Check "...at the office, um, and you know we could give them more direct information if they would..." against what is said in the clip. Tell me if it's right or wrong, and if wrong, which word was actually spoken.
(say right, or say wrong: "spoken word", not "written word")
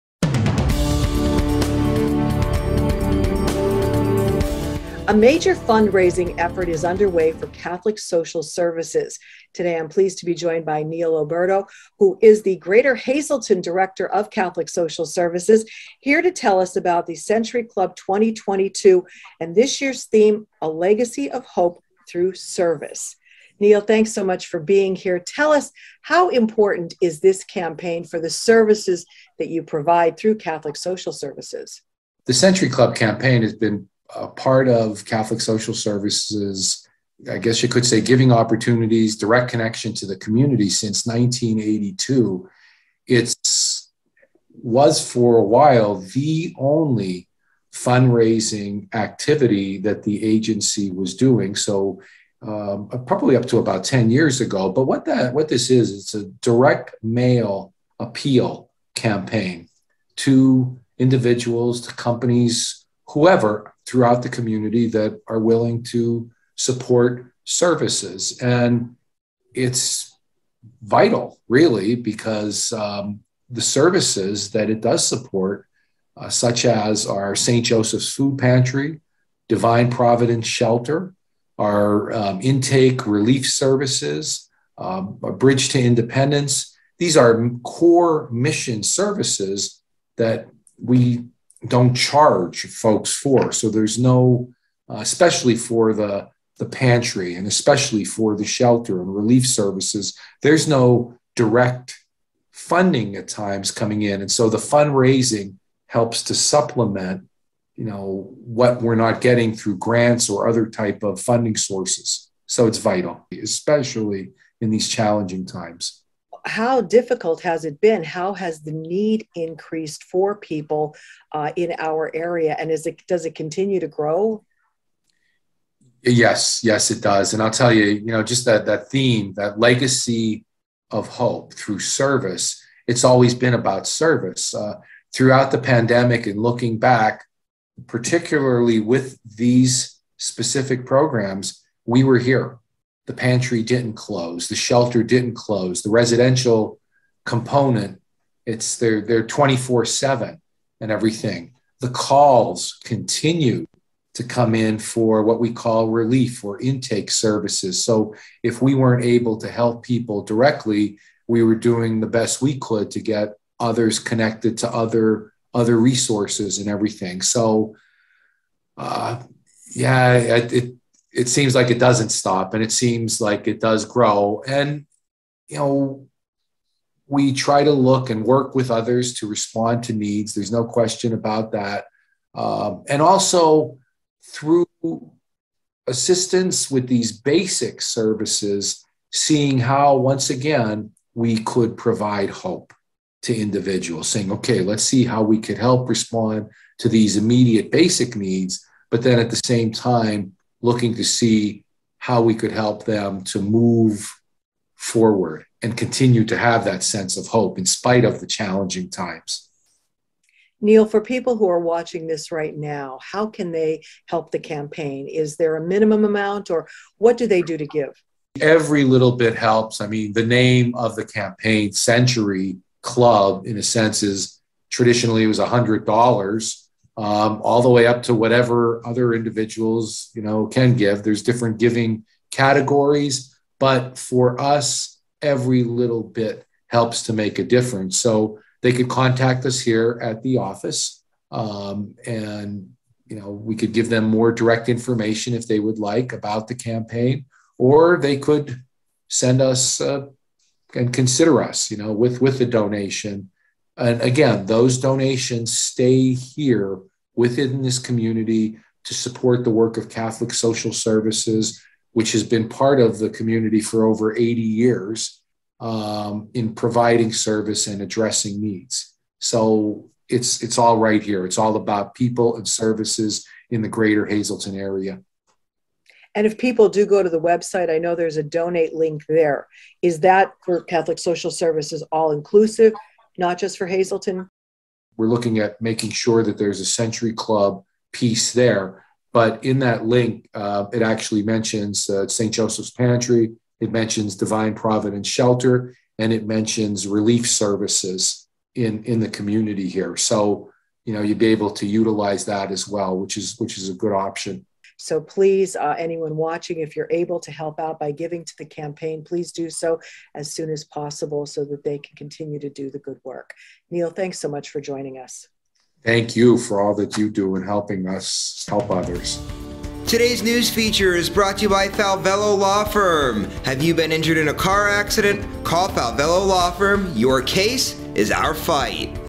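right.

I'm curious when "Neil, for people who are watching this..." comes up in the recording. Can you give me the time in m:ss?
3:30.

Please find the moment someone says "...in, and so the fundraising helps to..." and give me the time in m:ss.
1:44.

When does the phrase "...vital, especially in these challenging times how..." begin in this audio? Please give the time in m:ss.
1:52.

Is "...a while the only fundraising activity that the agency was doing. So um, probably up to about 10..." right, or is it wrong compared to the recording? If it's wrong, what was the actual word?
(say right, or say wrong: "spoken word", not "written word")
right.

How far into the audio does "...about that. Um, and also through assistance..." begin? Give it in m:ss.
3:01.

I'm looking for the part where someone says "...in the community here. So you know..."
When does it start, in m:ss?
4:58.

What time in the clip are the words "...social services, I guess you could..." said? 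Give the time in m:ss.
0:35.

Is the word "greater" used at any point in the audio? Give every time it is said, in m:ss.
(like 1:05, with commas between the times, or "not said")
0:12, 4:33.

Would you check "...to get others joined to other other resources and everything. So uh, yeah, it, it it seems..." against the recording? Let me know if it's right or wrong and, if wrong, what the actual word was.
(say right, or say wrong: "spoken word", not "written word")
wrong: "connected", not "joined".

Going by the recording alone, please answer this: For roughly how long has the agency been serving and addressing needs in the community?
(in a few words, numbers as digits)
over 80 years.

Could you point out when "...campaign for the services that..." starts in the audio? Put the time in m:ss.
0:27.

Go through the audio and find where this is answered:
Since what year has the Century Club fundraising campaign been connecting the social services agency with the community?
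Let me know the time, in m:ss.
0:41.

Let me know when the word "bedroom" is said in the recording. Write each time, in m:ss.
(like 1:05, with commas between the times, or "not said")
not said.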